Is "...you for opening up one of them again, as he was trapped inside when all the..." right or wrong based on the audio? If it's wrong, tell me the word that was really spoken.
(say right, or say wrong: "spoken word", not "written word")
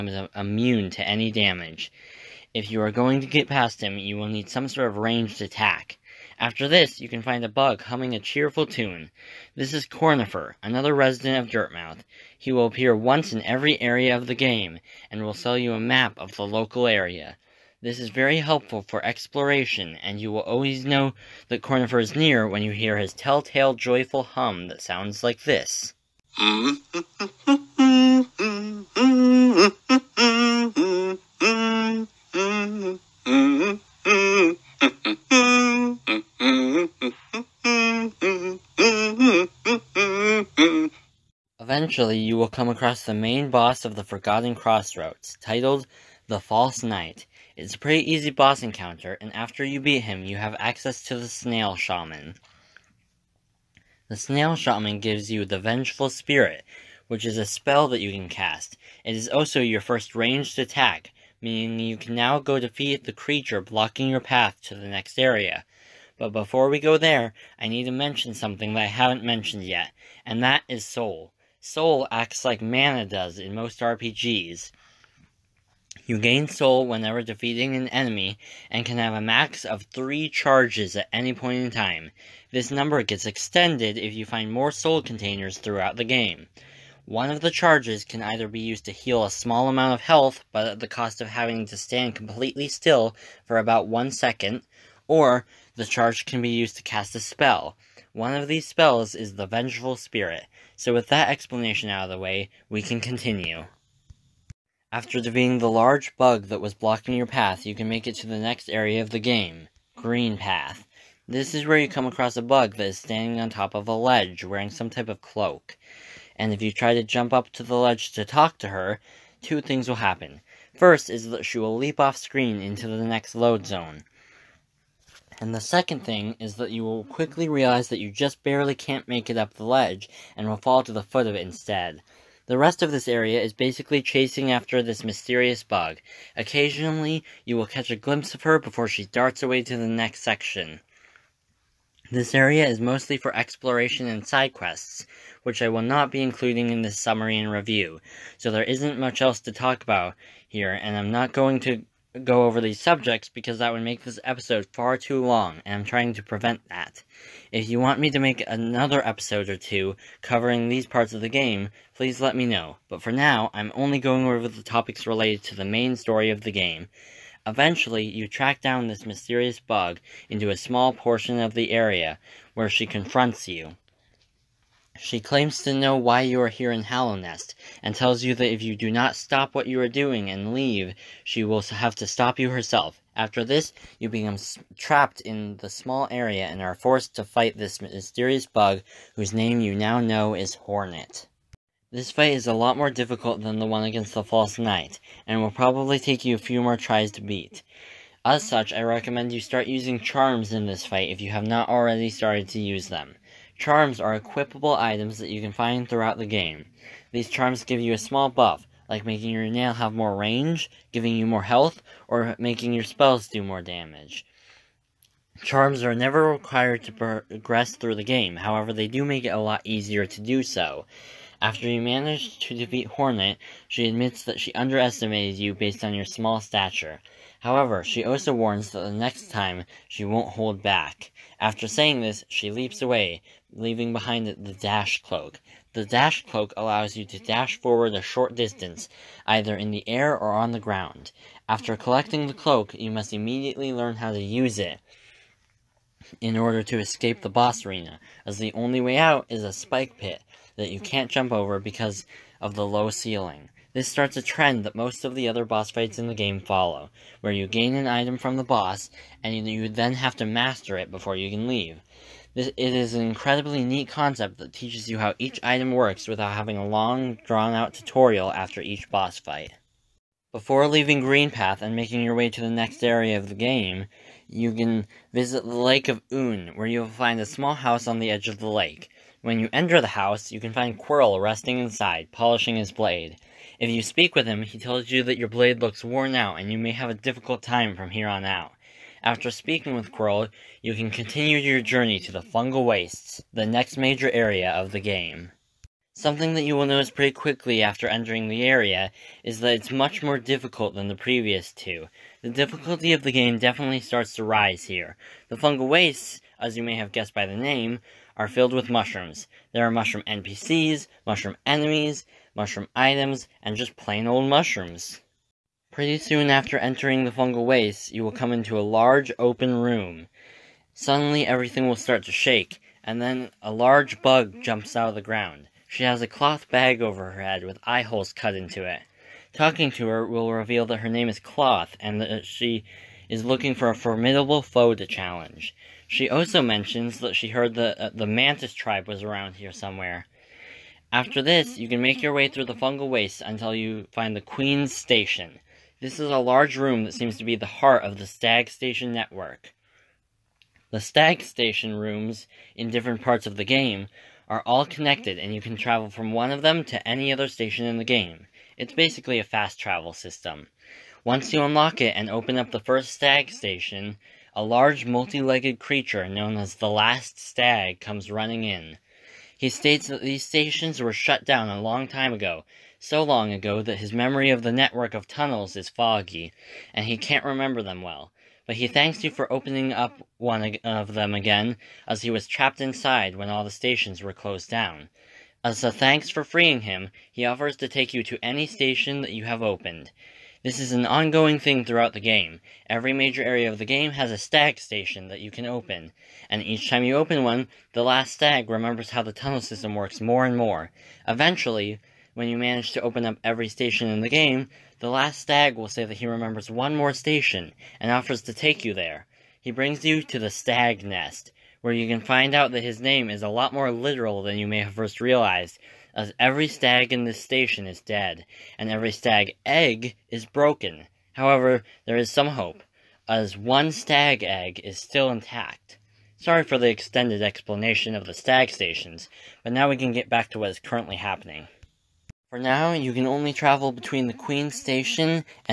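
right.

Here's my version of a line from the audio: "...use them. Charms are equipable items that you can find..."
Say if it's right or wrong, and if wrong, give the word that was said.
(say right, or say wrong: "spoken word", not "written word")
right.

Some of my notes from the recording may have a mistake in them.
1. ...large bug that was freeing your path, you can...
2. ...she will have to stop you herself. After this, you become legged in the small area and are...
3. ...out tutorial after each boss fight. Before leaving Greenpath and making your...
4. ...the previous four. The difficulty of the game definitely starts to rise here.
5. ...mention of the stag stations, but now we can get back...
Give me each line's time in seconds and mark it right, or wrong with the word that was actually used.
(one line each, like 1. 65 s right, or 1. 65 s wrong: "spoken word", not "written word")
1. 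105 s wrong: "blocking", not "freeing"
2. 181 s wrong: "trapped", not "legged"
3. 267 s right
4. 300 s wrong: "two", not "four"
5. 427 s wrong: "explanation", not "mention".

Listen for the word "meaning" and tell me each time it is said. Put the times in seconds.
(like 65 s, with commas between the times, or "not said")
61 s.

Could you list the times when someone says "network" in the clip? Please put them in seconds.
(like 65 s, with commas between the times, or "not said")
348 s, 374 s.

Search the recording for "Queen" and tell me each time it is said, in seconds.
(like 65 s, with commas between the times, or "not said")
344 s, 434 s.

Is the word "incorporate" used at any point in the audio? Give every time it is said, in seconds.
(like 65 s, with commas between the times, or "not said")
not said.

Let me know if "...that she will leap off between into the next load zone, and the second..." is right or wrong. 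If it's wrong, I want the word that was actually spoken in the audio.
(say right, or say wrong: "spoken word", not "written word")
wrong: "screen", not "between".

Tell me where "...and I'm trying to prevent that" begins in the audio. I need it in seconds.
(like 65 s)
155 s.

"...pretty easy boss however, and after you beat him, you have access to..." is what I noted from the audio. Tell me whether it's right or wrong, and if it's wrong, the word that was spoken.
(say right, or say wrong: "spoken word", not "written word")
wrong: "encounter", not "however".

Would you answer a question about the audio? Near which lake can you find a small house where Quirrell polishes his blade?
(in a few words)
Lake of Un.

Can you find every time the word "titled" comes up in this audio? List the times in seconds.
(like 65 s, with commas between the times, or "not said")
45 s.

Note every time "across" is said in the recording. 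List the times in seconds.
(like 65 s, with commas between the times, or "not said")
42 s, 112 s.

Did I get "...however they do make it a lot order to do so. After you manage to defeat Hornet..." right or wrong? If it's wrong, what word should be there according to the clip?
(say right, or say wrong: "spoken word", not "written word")
wrong: "easier", not "order".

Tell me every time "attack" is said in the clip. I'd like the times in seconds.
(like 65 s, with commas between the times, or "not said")
5 s, 60 s.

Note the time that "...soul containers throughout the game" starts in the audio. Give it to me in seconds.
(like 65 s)
84 s.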